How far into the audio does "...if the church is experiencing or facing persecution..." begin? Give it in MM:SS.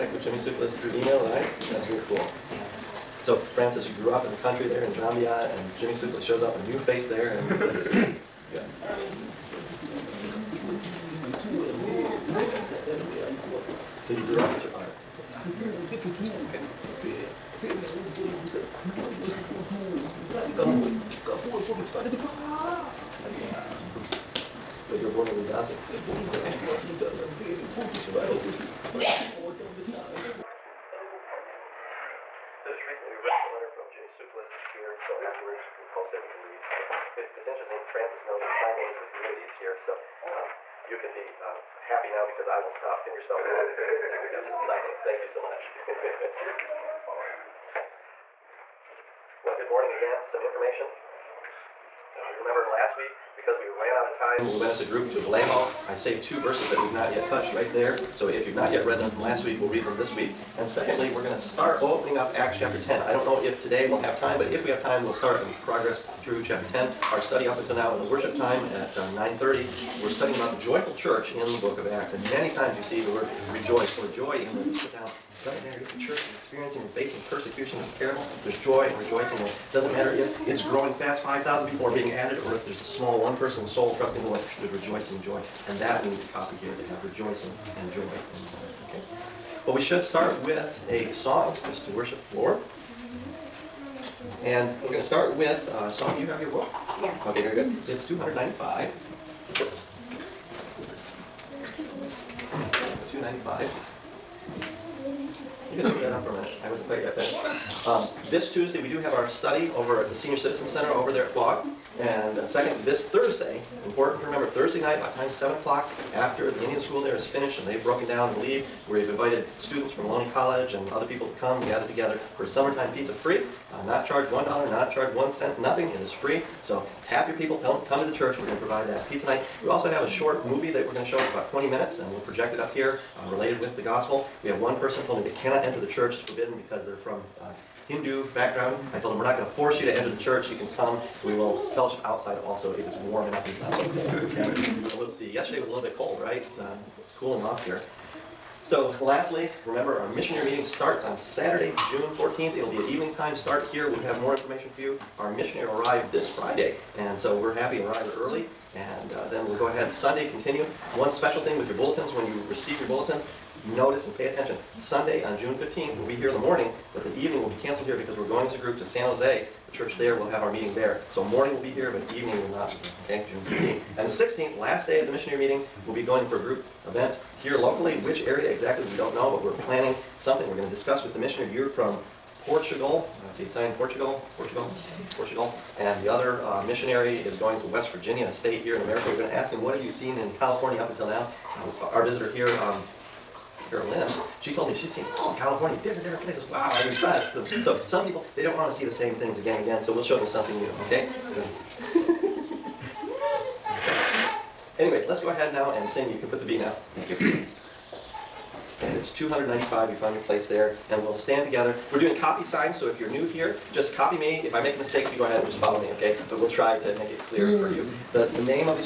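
01:15.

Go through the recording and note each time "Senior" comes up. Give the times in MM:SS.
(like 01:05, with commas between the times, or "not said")
01:50.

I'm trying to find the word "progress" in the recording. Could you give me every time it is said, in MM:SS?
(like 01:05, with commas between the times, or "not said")
01:05.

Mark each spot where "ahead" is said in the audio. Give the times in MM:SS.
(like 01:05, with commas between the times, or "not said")
02:39, 03:25, 03:35.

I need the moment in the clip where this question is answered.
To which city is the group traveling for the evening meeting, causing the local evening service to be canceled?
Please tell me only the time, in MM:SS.
02:48.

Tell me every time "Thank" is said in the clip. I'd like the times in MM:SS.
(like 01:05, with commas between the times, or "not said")
00:45, 03:26.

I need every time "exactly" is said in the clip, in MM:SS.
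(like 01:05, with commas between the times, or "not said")
02:58.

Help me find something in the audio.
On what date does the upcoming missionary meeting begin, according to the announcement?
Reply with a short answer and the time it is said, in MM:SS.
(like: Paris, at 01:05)
June 14th, at 02:31.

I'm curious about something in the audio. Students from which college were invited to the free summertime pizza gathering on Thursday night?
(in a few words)
Maloney College.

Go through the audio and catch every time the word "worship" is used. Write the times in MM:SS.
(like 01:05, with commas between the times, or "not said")
01:08, 01:31.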